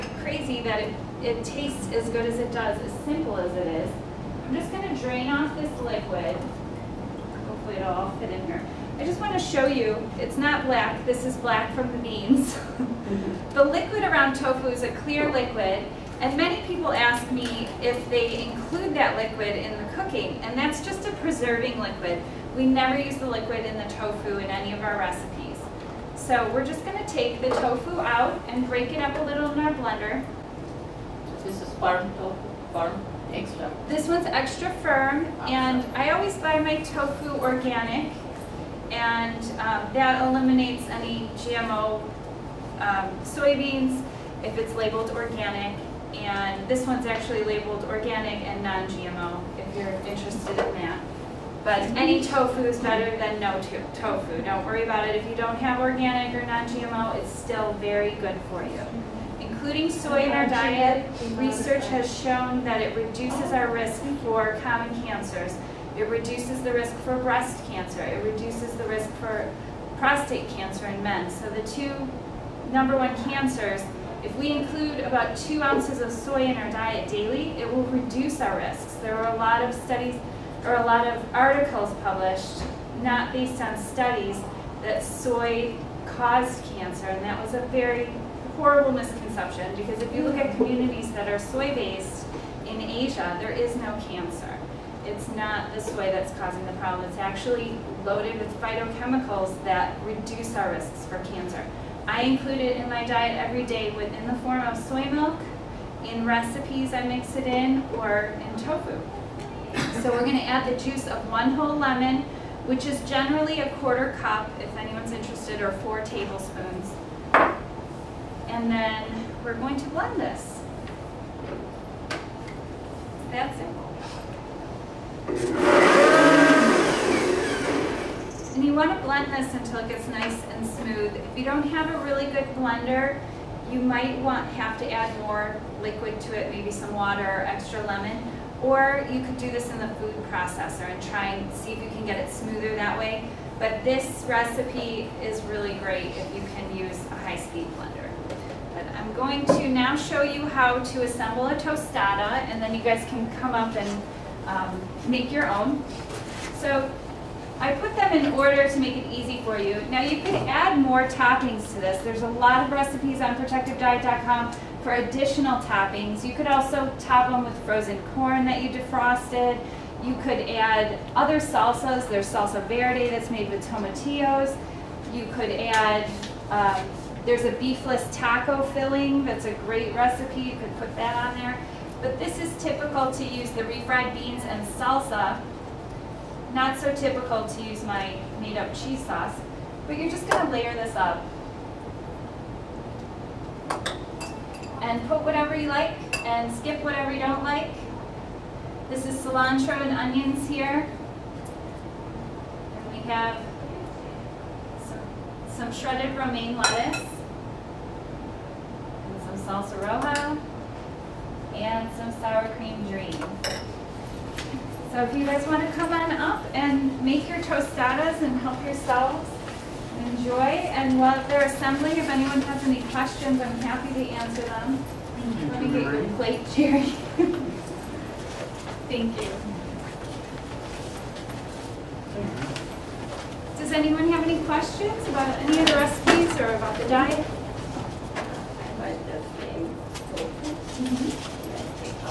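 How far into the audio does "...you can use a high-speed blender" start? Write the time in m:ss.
2:26.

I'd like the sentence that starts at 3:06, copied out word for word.
Not so typical to use my made up cheese sauce, but you're just gonna layer this up.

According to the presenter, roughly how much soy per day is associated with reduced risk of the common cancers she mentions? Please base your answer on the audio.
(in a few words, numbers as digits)
2 ounces.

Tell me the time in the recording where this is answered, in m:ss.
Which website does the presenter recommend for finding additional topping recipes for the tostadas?
2:43.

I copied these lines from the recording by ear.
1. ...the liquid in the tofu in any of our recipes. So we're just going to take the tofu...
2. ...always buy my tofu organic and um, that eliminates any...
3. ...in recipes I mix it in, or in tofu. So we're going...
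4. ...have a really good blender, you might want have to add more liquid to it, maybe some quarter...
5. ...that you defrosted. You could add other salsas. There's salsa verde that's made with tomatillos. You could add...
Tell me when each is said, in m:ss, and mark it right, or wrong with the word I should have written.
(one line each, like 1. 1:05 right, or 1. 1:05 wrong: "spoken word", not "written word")
1. 0:23 right
2. 0:36 right
3. 1:46 right
4. 2:11 wrong: "water", not "quarter"
5. 2:48 right.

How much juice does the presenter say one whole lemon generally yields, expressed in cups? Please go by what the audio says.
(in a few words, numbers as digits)
a quarter cup.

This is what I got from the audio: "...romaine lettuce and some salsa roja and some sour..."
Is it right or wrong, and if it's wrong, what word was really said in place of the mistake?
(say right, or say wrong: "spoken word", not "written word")
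right.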